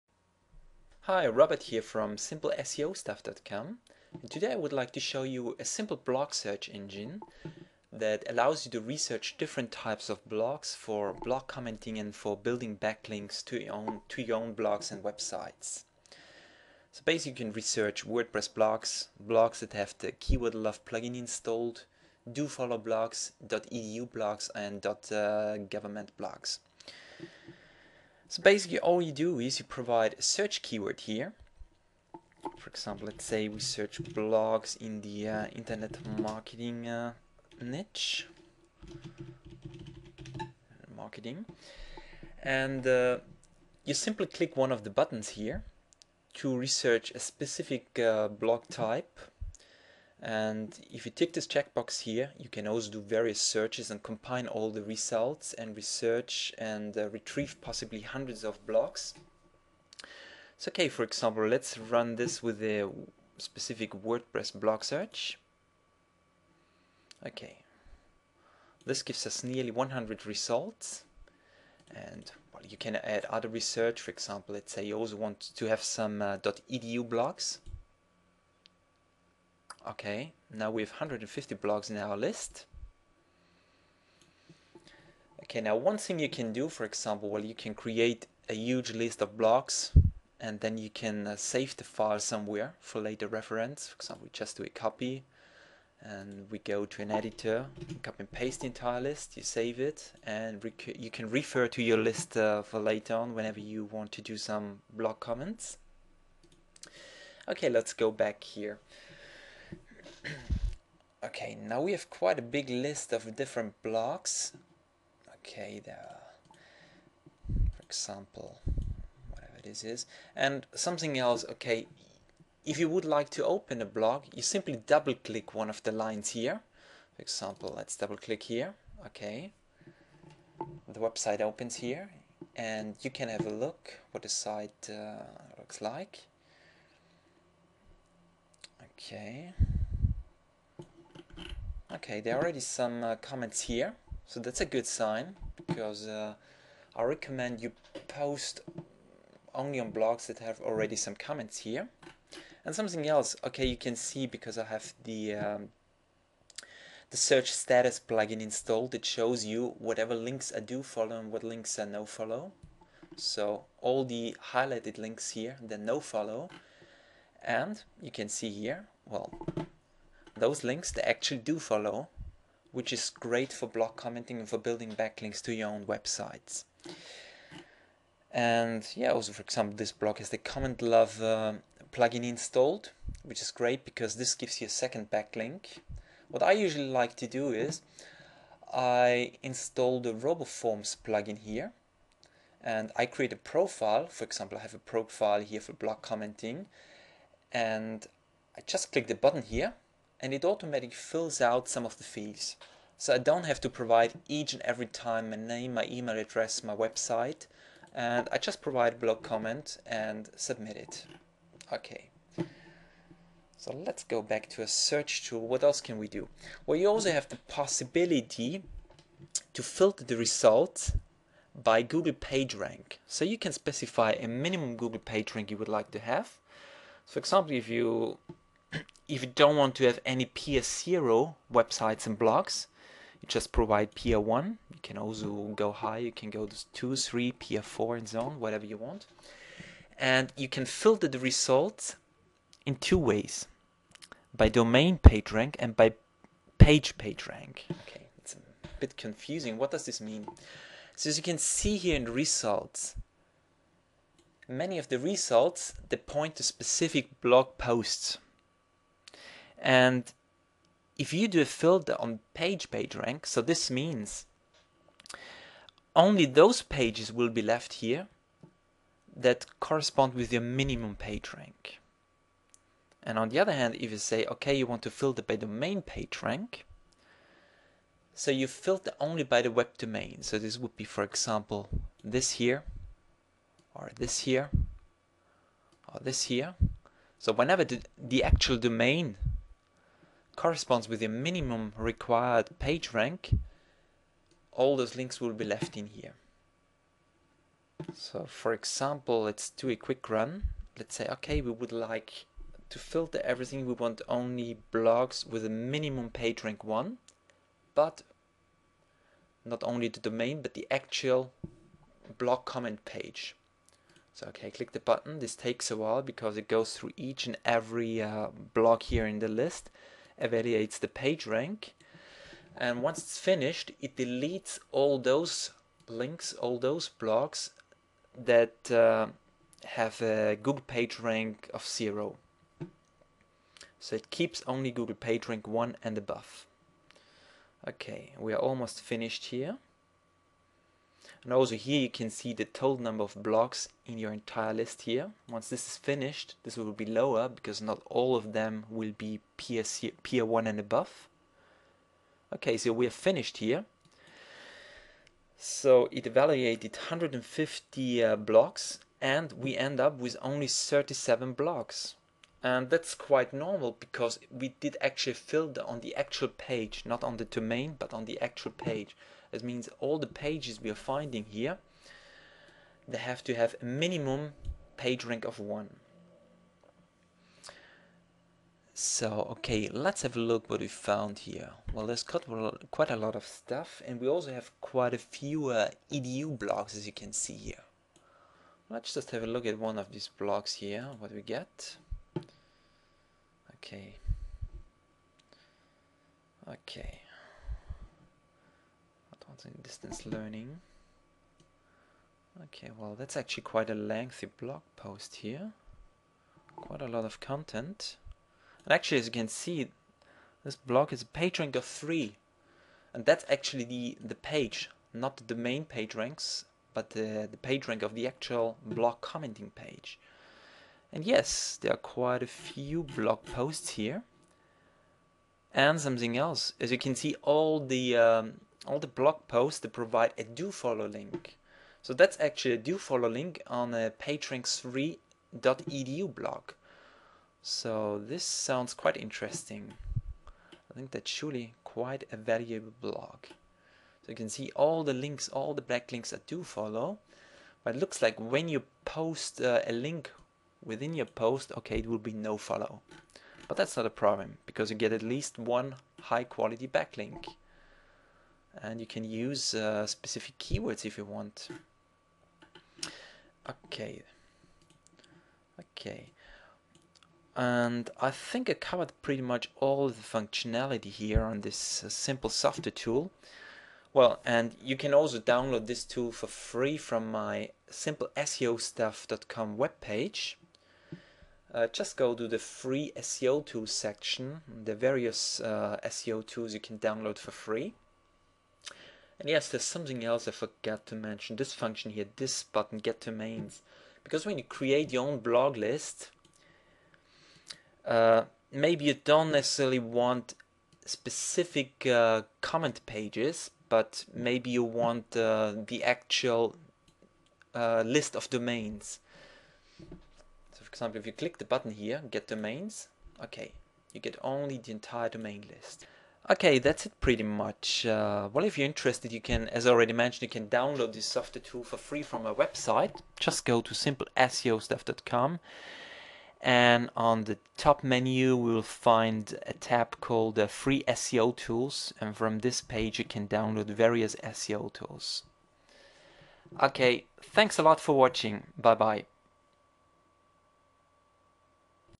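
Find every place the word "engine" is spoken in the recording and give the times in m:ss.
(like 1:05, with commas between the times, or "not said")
0:06.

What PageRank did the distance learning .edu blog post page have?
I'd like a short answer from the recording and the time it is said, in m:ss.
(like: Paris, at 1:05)
3, at 6:51.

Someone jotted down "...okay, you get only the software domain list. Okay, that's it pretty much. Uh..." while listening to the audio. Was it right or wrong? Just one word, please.
wrong.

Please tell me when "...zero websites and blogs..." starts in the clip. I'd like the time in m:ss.
3:50.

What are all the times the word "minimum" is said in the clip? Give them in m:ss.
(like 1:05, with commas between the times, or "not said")
3:44, 4:30, 4:51, 5:05, 6:13.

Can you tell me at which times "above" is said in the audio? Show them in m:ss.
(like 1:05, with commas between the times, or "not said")
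5:35, 5:50.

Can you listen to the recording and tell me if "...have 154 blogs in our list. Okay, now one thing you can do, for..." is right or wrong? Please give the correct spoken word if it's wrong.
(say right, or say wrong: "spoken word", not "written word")
wrong: "150", not "154".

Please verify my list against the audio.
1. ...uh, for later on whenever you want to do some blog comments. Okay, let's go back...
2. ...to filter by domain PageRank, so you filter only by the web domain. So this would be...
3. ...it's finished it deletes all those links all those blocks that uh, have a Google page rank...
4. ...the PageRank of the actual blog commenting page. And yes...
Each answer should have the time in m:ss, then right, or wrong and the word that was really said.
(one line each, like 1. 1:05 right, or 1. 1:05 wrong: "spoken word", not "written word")
1. 1:42 right
2. 4:34 right
3. 5:22 right
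4. 6:57 right.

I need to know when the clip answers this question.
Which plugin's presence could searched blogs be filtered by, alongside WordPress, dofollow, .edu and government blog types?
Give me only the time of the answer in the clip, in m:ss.
0:20.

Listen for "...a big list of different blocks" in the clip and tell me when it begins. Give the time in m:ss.
1:52.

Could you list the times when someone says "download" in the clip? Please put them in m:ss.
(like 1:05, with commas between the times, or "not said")
7:55, 8:06, 8:40, 8:53.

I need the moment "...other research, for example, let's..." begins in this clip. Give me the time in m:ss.
1:13.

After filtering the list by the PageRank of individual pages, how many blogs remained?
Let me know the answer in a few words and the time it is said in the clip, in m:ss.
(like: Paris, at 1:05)
37, at 6:00.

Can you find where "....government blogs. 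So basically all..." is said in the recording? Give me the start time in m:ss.
0:25.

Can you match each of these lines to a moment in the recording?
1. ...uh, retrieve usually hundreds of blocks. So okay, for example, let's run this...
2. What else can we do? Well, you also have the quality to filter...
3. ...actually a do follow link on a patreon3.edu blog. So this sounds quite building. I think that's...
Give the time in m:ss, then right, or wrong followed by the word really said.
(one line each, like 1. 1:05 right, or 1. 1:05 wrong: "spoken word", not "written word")
1. 0:56 wrong: "possibly", not "usually"
2. 3:35 wrong: "possibility", not "quality"
3. 7:12 wrong: "interesting", not "building".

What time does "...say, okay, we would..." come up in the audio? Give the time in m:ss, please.
5:00.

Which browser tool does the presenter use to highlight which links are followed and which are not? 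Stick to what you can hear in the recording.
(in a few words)
search status plugin.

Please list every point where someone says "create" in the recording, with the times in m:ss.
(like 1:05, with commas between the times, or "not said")
1:27, 3:13, 8:14.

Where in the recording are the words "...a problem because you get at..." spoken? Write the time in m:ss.
7:33.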